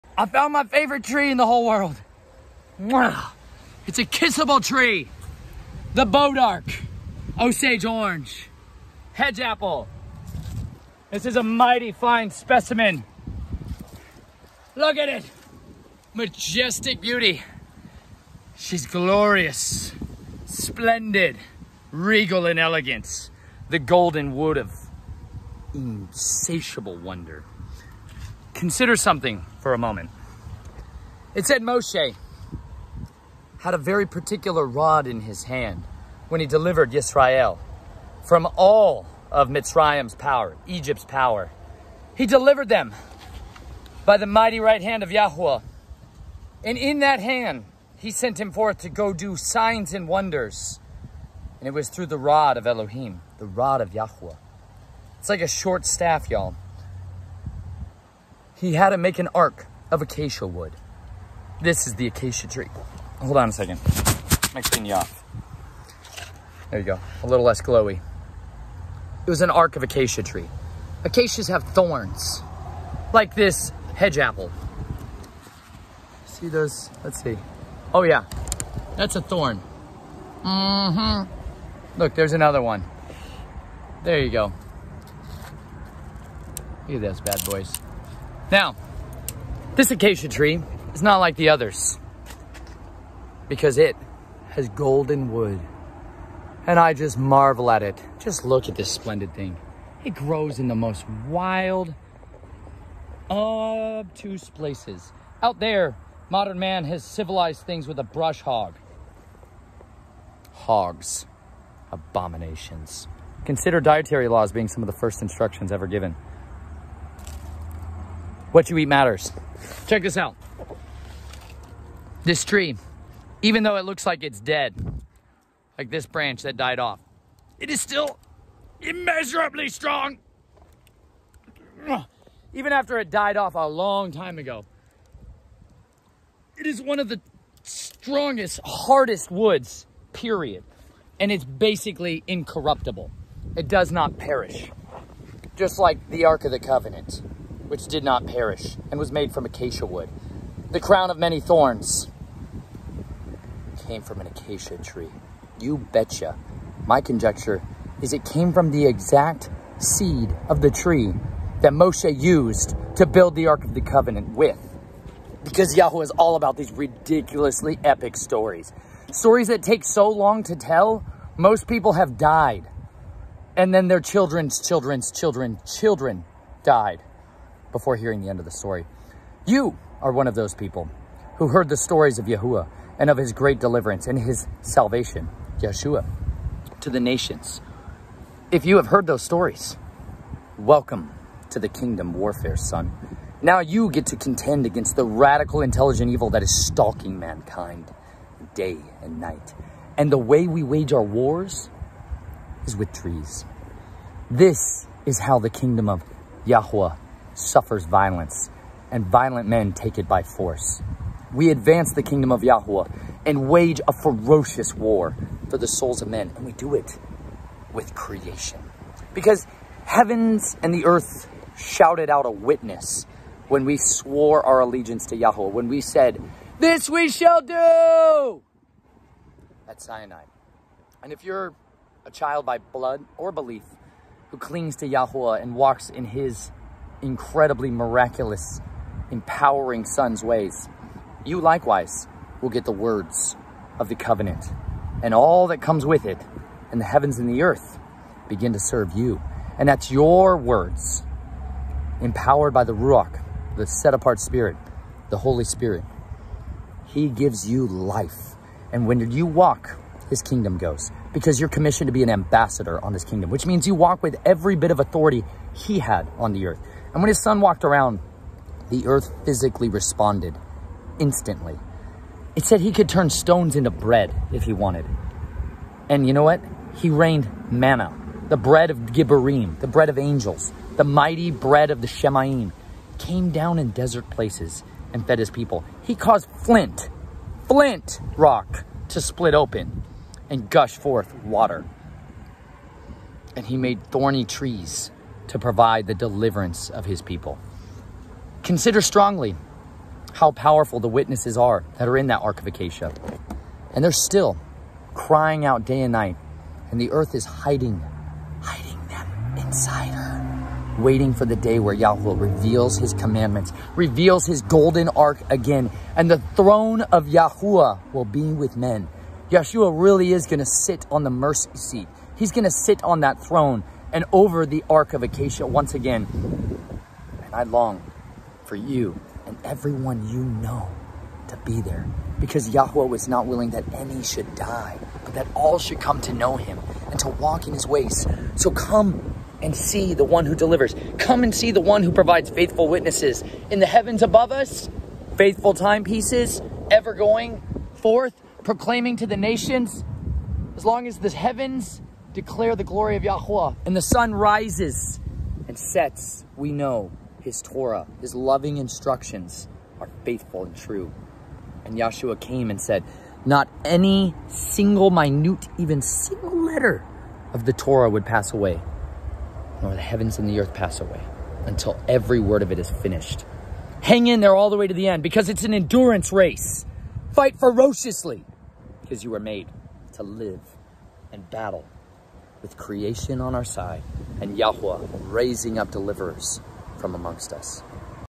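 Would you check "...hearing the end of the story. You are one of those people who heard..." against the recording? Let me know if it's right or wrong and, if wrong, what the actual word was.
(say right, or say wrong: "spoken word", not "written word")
right.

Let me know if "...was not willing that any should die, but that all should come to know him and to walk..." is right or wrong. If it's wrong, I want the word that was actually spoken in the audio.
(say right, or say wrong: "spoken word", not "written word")
right.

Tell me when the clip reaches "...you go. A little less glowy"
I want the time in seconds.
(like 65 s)
66 s.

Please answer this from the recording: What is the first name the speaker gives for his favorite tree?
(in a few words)
Bodark.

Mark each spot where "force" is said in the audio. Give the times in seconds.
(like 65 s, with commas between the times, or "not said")
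210 s.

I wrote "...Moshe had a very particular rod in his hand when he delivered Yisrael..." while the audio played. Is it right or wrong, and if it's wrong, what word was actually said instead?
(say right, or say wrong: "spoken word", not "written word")
right.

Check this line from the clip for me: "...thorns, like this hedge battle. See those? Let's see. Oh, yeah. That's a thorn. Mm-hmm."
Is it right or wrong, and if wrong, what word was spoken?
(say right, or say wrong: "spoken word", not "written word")
wrong: "apple", not "battle".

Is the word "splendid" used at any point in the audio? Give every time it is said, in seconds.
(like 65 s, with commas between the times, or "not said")
20 s, 98 s.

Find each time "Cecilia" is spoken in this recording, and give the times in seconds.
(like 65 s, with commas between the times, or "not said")
not said.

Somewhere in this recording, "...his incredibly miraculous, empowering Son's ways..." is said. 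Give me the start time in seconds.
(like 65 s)
236 s.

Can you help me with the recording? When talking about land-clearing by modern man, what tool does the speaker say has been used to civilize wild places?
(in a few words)
Brush hog.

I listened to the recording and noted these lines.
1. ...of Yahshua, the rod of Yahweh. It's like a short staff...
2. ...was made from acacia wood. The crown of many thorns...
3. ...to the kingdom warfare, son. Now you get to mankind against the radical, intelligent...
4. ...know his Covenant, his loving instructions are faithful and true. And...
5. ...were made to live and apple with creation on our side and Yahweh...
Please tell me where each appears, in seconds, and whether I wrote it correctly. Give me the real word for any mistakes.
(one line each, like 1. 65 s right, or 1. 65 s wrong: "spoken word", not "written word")
1. 52 s wrong: "Elohim", not "Yahshua"
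2. 148 s right
3. 191 s wrong: "contend", not "mankind"
4. 356 s wrong: "Torah", not "Covenant"
5. 379 s wrong: "battle", not "apple".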